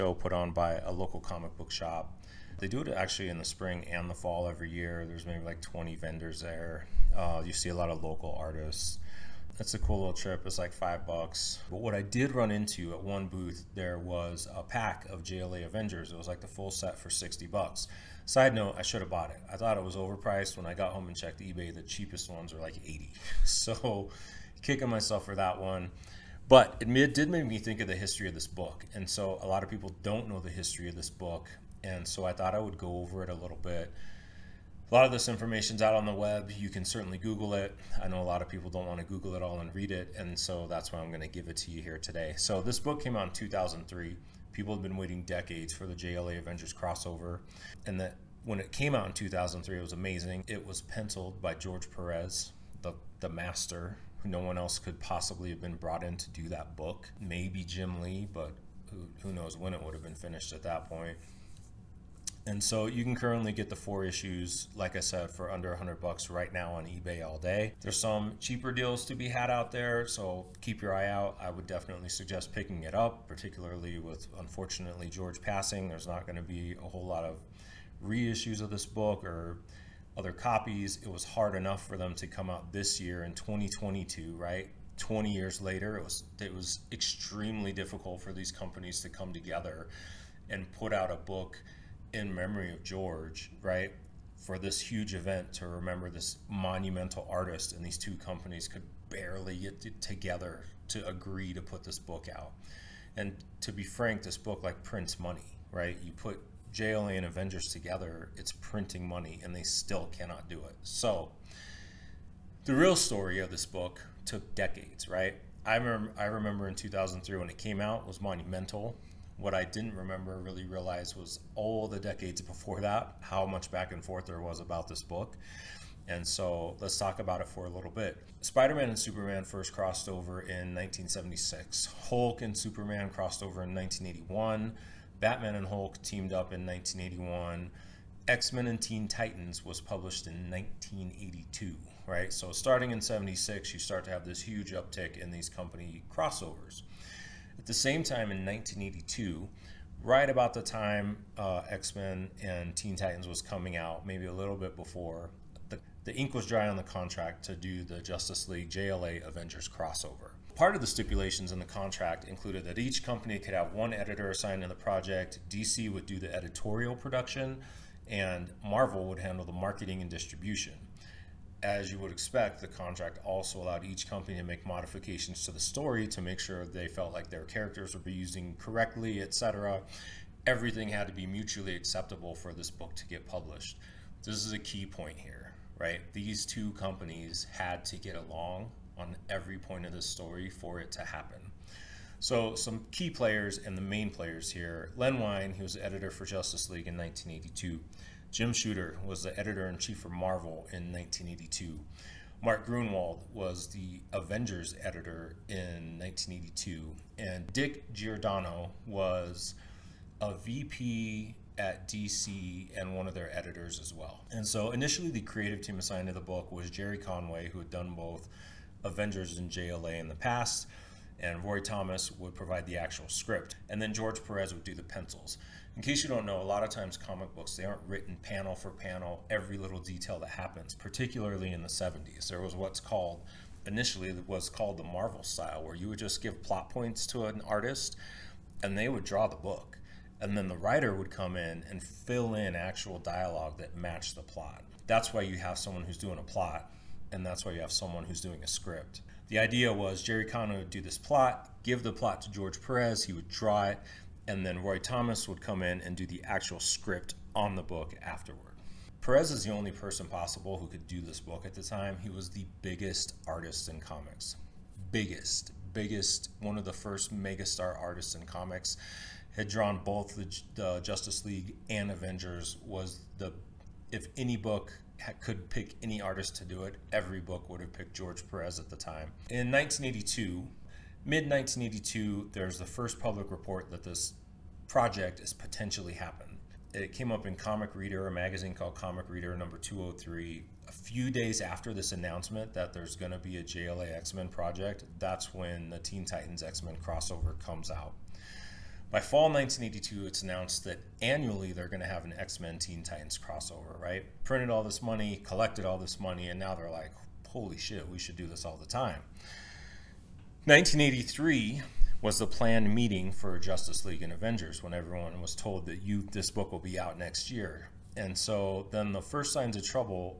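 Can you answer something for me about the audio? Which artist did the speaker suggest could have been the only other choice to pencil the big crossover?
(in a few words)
Jim Lee.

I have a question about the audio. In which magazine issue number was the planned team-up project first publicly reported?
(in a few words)
203.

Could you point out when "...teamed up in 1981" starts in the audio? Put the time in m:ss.
2:16.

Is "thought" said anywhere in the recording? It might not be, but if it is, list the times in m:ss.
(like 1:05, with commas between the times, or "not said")
0:19, 0:32.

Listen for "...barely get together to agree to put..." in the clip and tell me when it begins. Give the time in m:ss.
1:39.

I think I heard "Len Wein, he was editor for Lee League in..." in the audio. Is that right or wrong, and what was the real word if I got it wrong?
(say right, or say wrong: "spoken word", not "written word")
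wrong: "Justice", not "Lee".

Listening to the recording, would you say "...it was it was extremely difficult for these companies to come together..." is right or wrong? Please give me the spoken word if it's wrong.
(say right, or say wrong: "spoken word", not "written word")
right.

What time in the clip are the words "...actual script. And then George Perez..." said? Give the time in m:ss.
3:42.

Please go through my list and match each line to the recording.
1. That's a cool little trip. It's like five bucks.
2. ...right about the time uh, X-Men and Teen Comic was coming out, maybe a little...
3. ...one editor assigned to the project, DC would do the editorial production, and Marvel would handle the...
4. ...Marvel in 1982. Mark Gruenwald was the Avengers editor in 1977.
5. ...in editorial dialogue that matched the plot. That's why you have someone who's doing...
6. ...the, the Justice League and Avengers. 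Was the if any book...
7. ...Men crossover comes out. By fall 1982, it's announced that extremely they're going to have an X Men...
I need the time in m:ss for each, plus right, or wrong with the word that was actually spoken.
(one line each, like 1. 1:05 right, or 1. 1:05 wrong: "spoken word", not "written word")
1. 0:09 right
2. 2:30 wrong: "Titans", not "Comic"
3. 2:43 right
4. 3:20 wrong: "1982", not "1977"
5. 4:02 wrong: "actual", not "editorial"
6. 4:30 right
7. 4:56 wrong: "annually", not "extremely".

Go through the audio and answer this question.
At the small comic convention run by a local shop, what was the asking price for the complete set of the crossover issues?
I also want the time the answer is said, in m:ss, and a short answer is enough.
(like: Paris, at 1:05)
$60, at 0:17.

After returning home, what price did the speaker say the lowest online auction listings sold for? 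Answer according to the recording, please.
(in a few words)
80.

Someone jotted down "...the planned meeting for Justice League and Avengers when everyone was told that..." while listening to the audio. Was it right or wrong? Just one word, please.
right.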